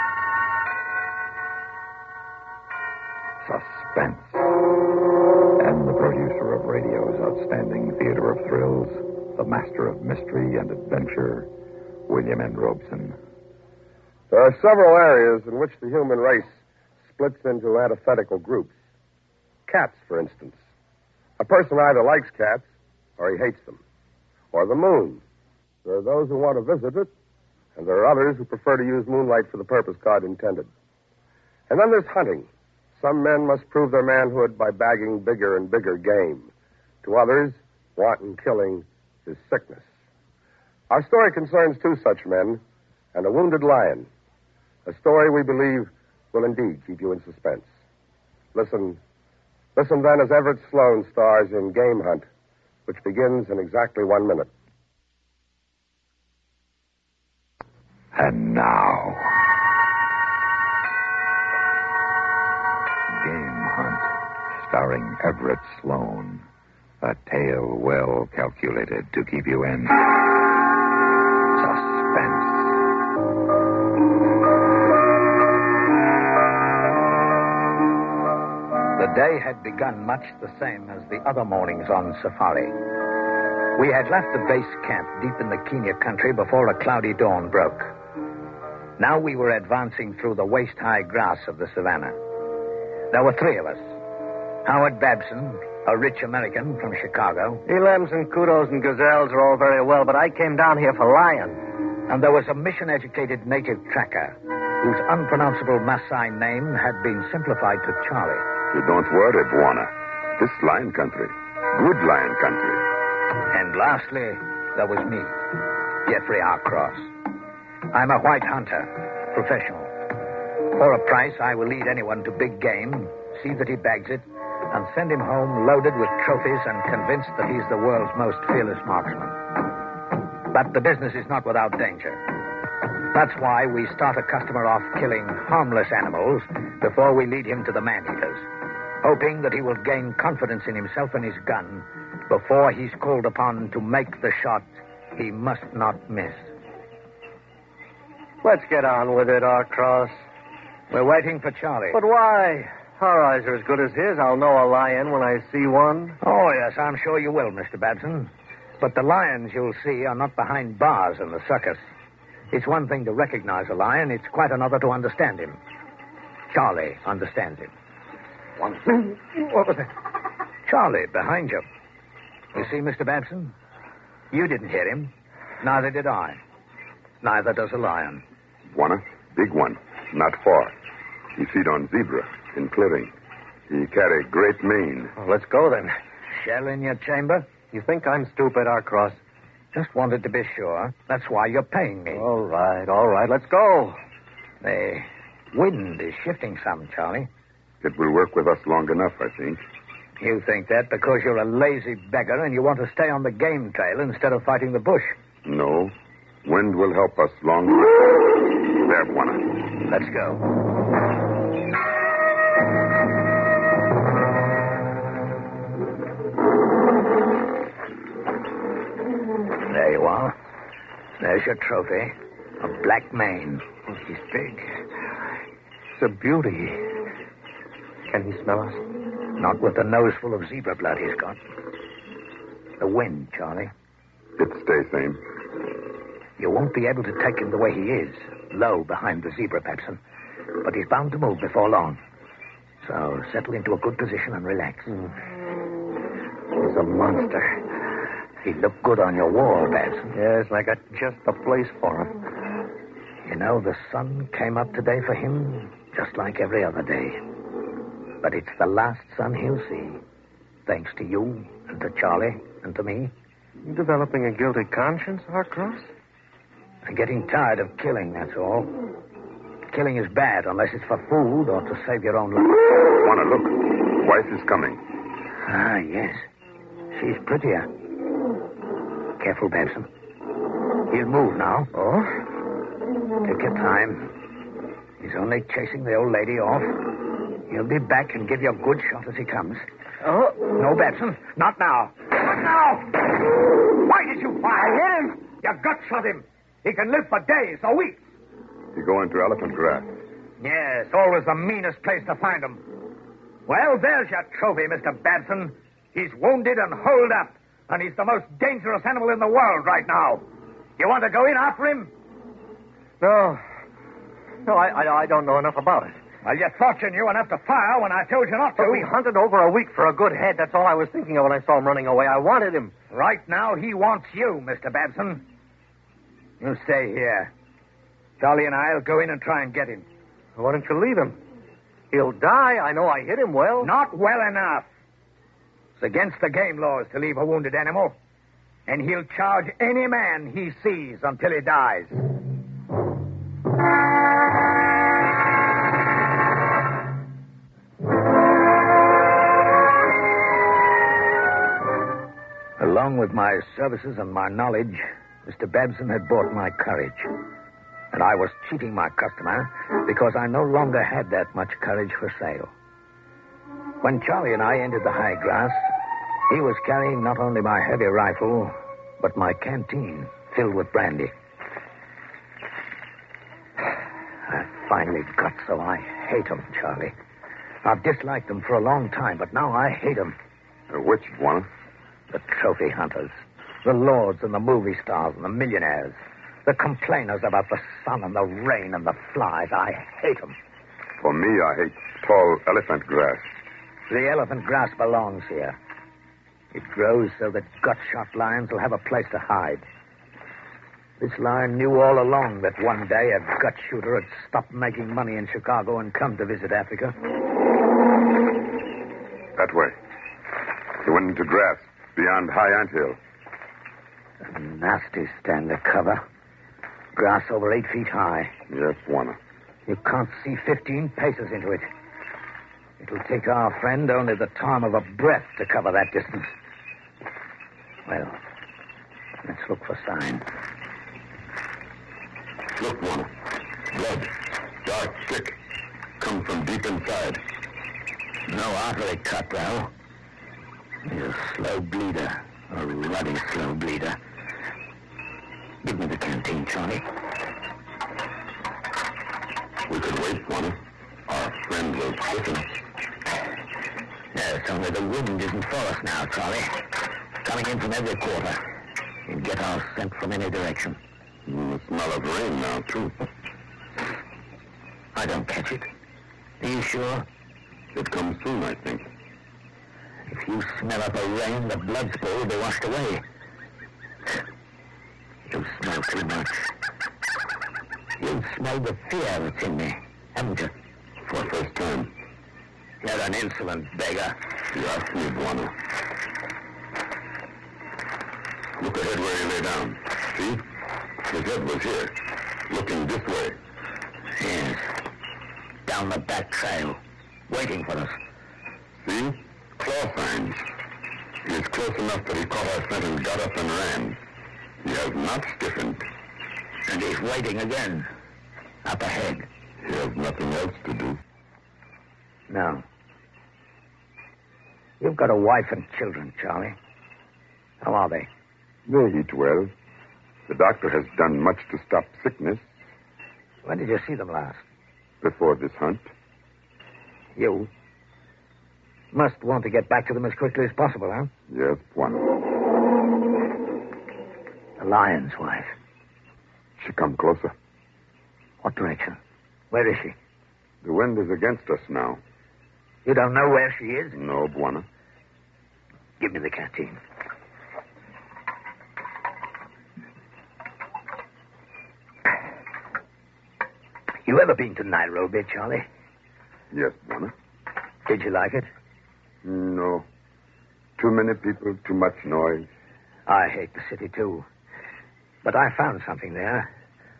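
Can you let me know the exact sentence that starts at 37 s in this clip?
To others, wanton killing is sickness.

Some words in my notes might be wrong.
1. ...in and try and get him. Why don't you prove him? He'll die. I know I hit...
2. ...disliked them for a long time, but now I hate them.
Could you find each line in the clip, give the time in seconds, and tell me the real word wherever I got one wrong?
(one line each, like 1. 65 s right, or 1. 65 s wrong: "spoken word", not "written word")
1. 329 s wrong: "leave", not "prove"
2. 377 s right.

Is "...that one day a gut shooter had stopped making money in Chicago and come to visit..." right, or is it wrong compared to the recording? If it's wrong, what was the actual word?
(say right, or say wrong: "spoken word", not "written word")
right.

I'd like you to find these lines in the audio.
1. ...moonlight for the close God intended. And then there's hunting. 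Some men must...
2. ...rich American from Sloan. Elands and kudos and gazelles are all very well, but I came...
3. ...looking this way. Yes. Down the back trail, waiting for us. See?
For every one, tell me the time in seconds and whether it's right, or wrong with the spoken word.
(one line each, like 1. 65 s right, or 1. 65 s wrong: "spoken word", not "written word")
1. 29 s wrong: "purpose", not "close"
2. 95 s wrong: "Chicago", not "Sloan"
3. 492 s right.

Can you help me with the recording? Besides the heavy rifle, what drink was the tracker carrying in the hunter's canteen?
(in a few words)
Brandy.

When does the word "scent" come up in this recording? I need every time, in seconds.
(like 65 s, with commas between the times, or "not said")
459 s, 502 s.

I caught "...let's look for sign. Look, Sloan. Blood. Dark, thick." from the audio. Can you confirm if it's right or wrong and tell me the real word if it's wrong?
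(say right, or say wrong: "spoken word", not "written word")
wrong: "Warner", not "Sloan".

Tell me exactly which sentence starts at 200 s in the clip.
You think that because you're a lazy beggar and you want to stay on the game trail instead of fighting the bush.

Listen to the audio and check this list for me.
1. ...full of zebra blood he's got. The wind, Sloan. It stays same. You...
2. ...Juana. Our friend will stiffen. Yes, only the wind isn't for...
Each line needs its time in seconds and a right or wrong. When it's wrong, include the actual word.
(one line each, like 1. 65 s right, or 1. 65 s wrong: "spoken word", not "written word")
1. 230 s wrong: "Charlie", not "Sloan"
2. 450 s right.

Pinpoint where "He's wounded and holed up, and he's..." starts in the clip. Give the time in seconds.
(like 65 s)
305 s.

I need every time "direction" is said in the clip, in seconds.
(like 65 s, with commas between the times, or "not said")
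460 s, 538 s.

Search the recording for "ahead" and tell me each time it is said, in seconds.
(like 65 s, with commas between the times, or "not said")
488 s, 508 s.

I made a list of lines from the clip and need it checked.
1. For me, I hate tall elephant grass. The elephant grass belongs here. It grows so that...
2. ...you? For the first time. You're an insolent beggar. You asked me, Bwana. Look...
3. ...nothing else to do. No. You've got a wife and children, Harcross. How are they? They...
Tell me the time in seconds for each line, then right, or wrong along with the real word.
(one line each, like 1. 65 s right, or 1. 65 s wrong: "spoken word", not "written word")
1. 391 s right
2. 480 s right
3. 509 s wrong: "Charlie", not "Harcross".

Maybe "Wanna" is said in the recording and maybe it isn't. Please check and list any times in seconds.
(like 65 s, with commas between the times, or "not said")
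178 s, 272 s.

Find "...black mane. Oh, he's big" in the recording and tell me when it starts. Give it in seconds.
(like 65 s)
222 s.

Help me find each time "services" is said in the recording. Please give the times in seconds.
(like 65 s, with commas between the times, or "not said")
353 s.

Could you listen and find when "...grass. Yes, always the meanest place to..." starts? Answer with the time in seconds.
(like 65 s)
299 s.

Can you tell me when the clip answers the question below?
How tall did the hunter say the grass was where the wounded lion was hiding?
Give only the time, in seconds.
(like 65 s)
417 s.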